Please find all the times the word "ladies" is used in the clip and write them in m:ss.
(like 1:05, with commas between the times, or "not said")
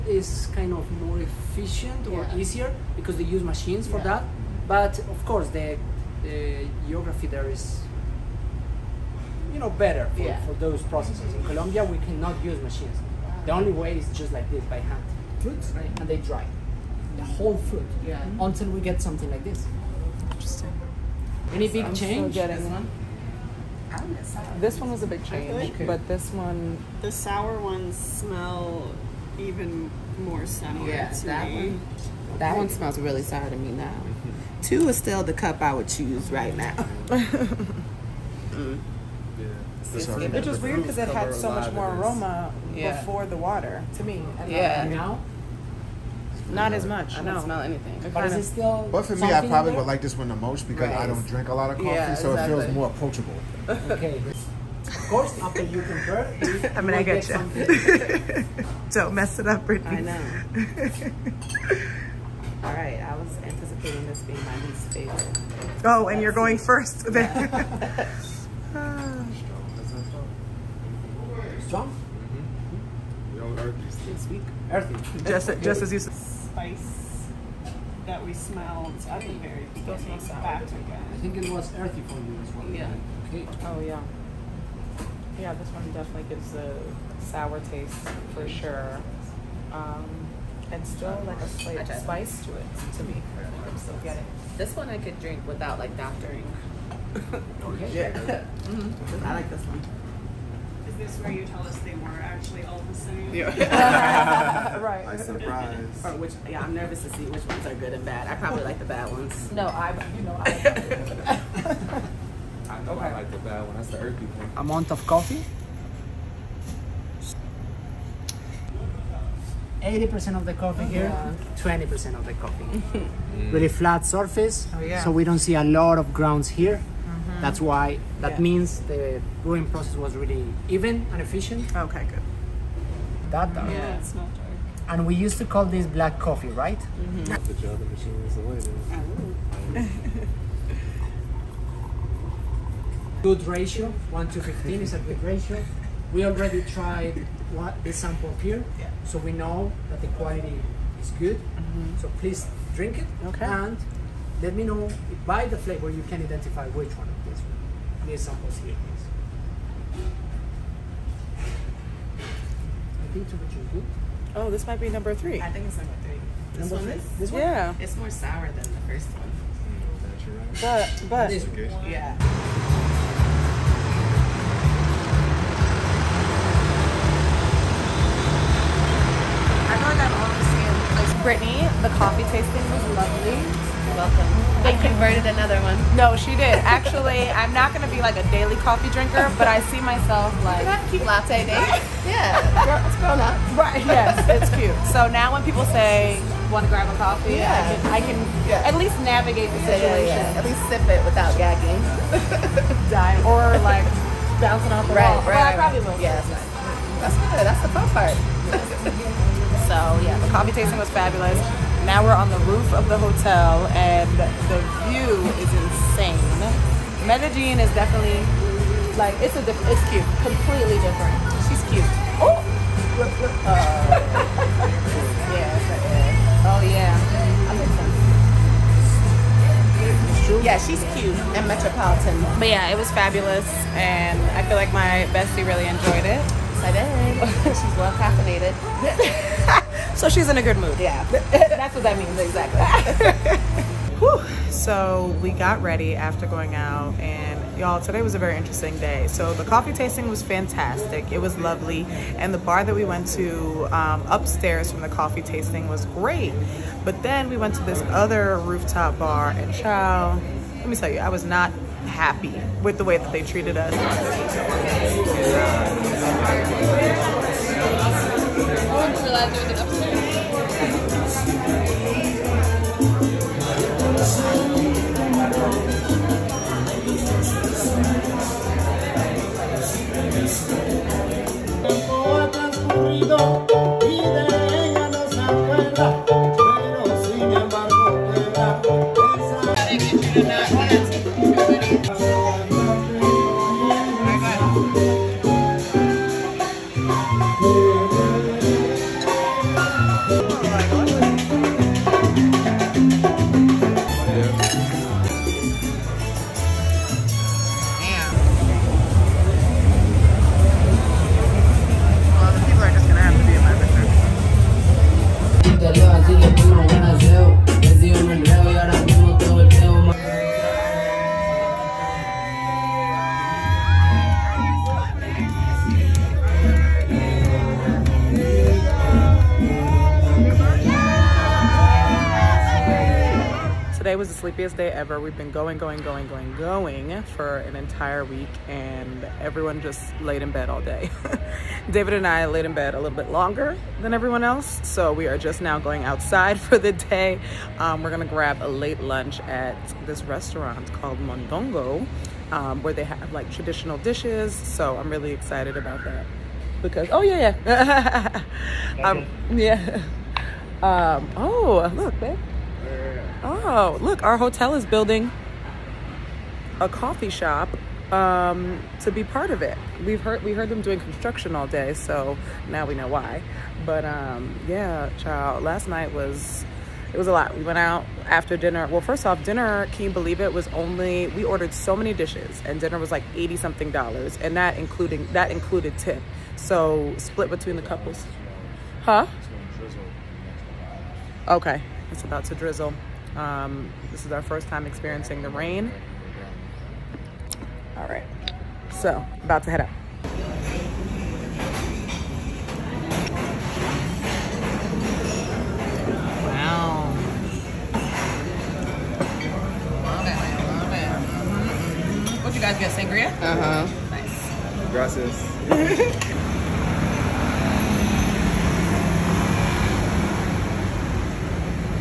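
not said.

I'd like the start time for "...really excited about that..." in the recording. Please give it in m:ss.
5:54.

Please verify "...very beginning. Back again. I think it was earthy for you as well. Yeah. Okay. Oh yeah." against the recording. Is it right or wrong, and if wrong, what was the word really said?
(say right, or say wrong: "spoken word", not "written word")
right.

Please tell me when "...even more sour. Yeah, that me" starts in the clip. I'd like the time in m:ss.
0:29.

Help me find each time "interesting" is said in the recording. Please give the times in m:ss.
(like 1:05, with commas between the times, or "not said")
0:20, 4:08.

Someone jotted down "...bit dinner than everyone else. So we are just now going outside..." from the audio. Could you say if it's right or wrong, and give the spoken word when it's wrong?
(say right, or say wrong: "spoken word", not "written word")
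wrong: "longer", not "dinner".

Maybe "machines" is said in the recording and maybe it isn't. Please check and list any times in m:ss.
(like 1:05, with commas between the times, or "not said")
0:03, 0:12, 2:17.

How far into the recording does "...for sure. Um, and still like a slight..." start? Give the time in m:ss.
1:28.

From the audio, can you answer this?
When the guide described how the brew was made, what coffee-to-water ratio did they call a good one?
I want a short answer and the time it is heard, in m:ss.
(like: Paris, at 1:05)
1 to 15, at 2:24.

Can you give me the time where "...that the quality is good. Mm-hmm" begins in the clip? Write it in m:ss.
2:29.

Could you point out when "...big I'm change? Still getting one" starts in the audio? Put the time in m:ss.
0:21.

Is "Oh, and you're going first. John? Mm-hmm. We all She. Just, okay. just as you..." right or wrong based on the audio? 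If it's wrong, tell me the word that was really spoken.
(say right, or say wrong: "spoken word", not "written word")
wrong: "Earthy", not "She".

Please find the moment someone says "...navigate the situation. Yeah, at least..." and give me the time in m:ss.
3:18.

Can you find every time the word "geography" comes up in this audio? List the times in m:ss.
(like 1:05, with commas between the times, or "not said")
0:06.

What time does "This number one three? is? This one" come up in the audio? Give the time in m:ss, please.
2:46.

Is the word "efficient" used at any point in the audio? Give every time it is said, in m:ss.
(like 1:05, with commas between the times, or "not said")
0:01, 2:11.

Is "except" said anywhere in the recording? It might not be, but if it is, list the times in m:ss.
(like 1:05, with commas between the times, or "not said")
not said.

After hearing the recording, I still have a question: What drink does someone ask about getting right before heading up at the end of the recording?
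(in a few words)
Sangria.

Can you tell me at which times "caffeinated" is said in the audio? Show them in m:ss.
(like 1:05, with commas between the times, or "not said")
3:57.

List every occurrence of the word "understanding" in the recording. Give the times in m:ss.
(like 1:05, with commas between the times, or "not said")
not said.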